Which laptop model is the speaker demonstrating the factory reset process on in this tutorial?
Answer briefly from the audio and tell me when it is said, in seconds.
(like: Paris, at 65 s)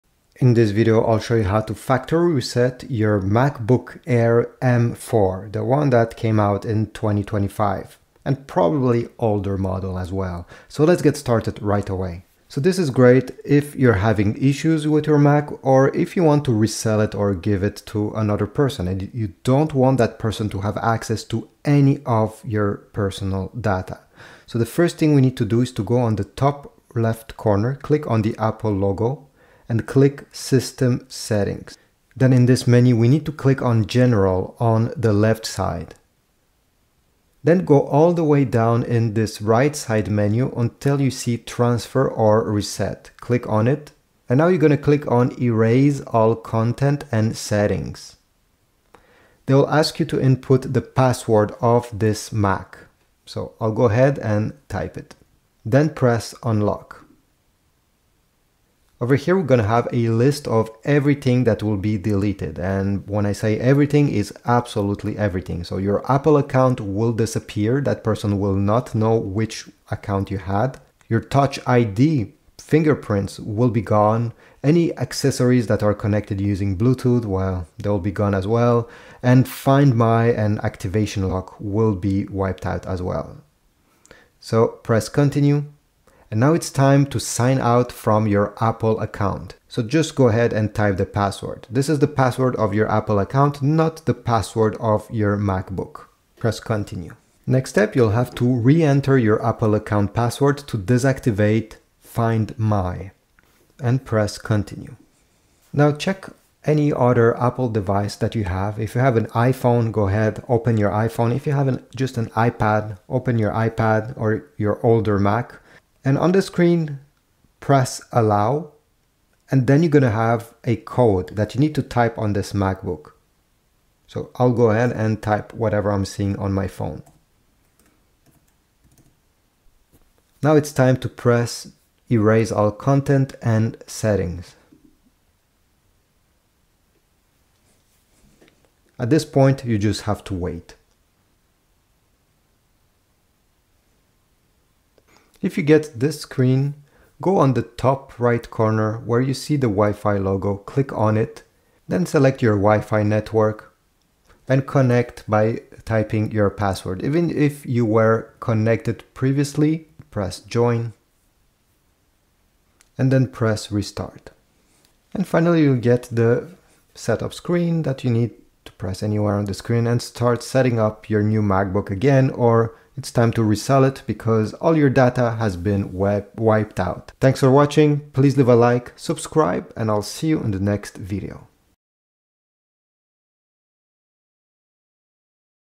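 MacBook Air M4, at 3 s.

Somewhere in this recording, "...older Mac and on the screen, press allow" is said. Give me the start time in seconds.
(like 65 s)
114 s.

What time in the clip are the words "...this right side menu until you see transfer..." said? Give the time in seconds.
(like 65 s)
39 s.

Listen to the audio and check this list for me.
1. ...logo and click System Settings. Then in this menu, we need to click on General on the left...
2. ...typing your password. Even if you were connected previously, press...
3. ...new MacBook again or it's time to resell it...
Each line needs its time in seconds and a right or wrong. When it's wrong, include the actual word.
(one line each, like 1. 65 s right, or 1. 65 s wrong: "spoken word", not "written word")
1. 28 s right
2. 155 s right
3. 171 s right.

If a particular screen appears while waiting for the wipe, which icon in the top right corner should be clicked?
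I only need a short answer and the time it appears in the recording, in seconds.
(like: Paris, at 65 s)
Wi-Fi logo, at 149 s.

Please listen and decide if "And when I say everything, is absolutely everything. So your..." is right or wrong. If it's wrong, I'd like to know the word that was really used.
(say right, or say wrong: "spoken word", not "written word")
right.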